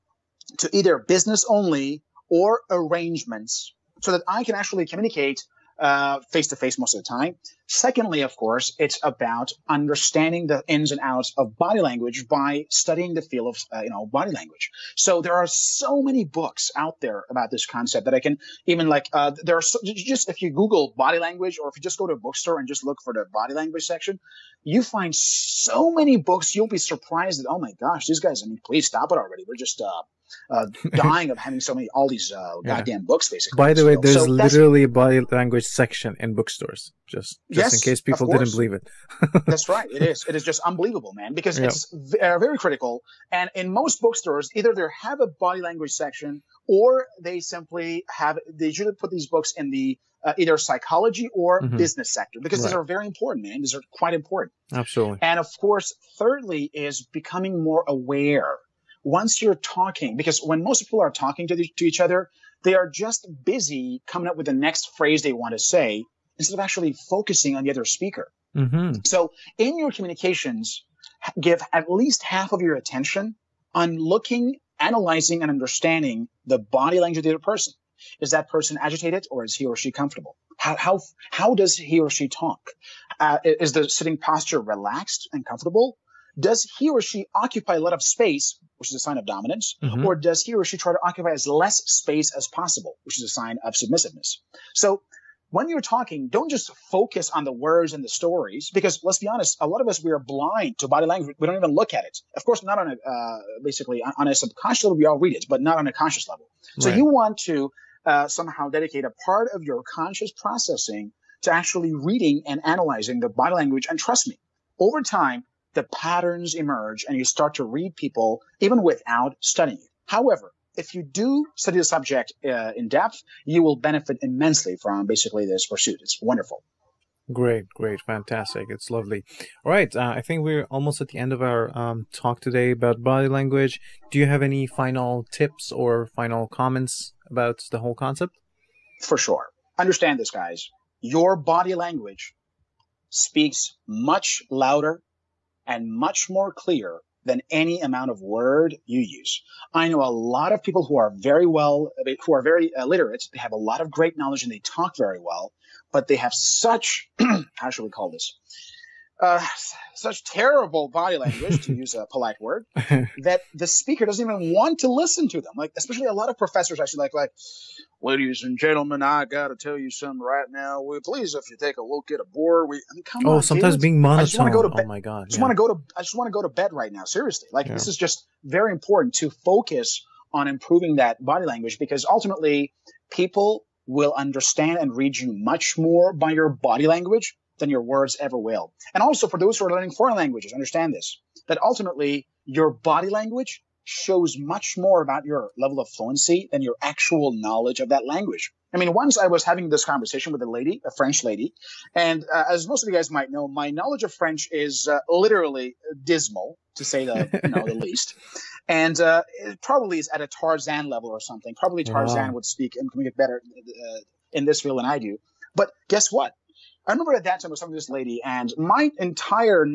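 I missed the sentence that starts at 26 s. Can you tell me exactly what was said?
You'll be surprised that oh my gosh, these guys!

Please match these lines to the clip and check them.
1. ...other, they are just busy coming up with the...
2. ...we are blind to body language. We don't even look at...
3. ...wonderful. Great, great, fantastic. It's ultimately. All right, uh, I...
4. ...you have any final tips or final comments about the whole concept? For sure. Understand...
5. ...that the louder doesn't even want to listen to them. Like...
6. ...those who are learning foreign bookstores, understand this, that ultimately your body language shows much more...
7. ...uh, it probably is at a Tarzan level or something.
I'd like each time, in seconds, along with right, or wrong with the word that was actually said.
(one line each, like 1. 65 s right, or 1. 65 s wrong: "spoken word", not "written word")
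1. 61 s right
2. 100 s right
3. 126 s wrong: "lovely", not "ultimately"
4. 134 s right
5. 163 s wrong: "speaker", not "louder"
6. 189 s wrong: "languages", not "bookstores"
7. 208 s right.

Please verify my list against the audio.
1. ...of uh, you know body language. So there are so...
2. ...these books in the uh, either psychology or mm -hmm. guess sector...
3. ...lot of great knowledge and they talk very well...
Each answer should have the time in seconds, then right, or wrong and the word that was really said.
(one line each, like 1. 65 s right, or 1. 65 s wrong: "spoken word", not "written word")
1. 13 s right
2. 49 s wrong: "business", not "guess"
3. 153 s right.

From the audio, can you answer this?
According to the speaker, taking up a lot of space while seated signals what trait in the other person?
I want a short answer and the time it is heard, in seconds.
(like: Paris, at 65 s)
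dominance, at 89 s.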